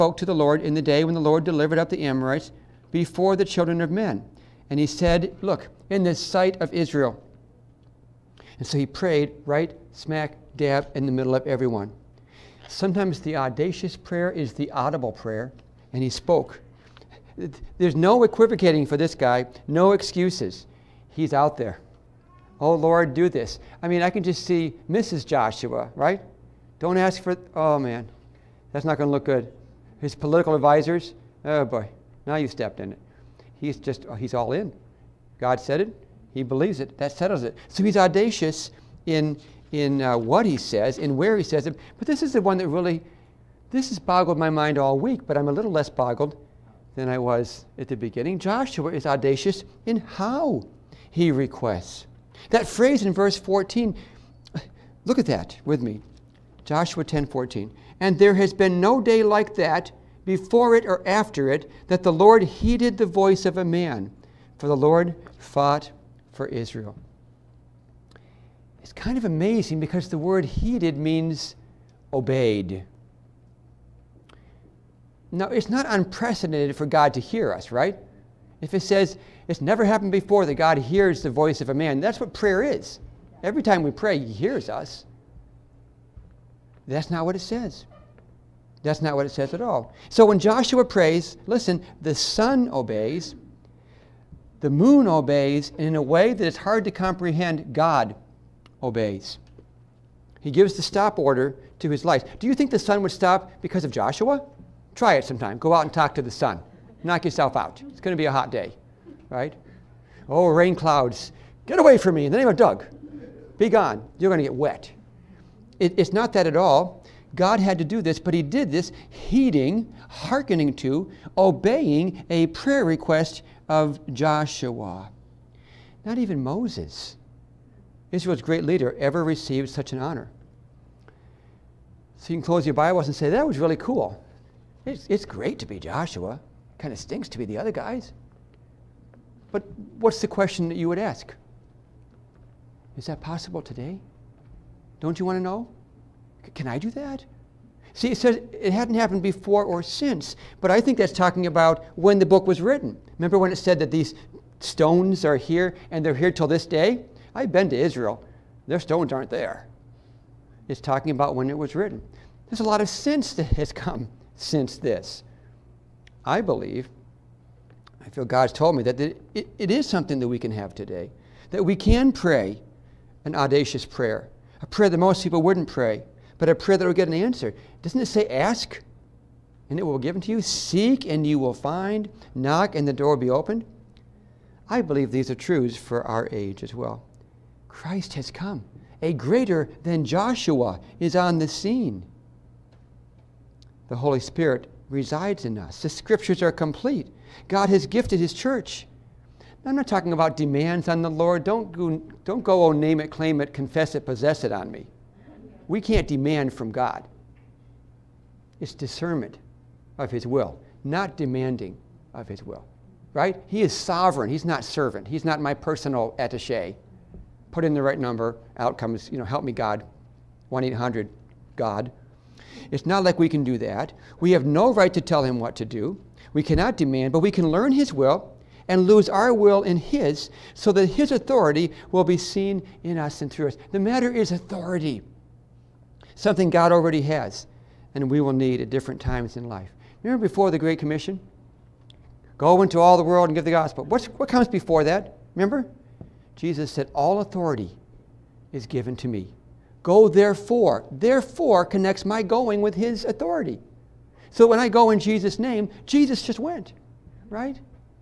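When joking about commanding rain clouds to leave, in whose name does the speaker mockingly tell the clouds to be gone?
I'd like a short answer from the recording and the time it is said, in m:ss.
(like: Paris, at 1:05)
Doug, at 1:52.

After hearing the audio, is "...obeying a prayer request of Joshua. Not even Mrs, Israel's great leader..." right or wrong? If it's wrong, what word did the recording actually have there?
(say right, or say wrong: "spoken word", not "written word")
wrong: "Moses", not "Mrs".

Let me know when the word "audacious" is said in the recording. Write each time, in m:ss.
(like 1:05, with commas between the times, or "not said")
0:13, 0:37, 0:49, 2:53.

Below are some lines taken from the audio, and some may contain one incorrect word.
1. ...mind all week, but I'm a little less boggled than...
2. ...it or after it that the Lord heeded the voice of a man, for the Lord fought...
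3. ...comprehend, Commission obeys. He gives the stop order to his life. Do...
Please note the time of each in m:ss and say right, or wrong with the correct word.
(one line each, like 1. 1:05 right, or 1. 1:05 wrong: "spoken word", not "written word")
1. 0:44 right
2. 1:00 right
3. 1:36 wrong: "God", not "Commission".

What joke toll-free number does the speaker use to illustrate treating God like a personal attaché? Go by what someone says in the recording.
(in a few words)
1 800 God.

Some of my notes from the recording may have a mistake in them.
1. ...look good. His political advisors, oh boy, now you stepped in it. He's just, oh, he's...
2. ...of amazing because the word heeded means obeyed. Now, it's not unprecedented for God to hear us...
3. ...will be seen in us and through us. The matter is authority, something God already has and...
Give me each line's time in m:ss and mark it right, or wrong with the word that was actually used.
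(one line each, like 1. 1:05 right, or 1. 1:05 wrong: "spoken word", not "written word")
1. 0:29 right
2. 1:09 right
3. 3:51 right.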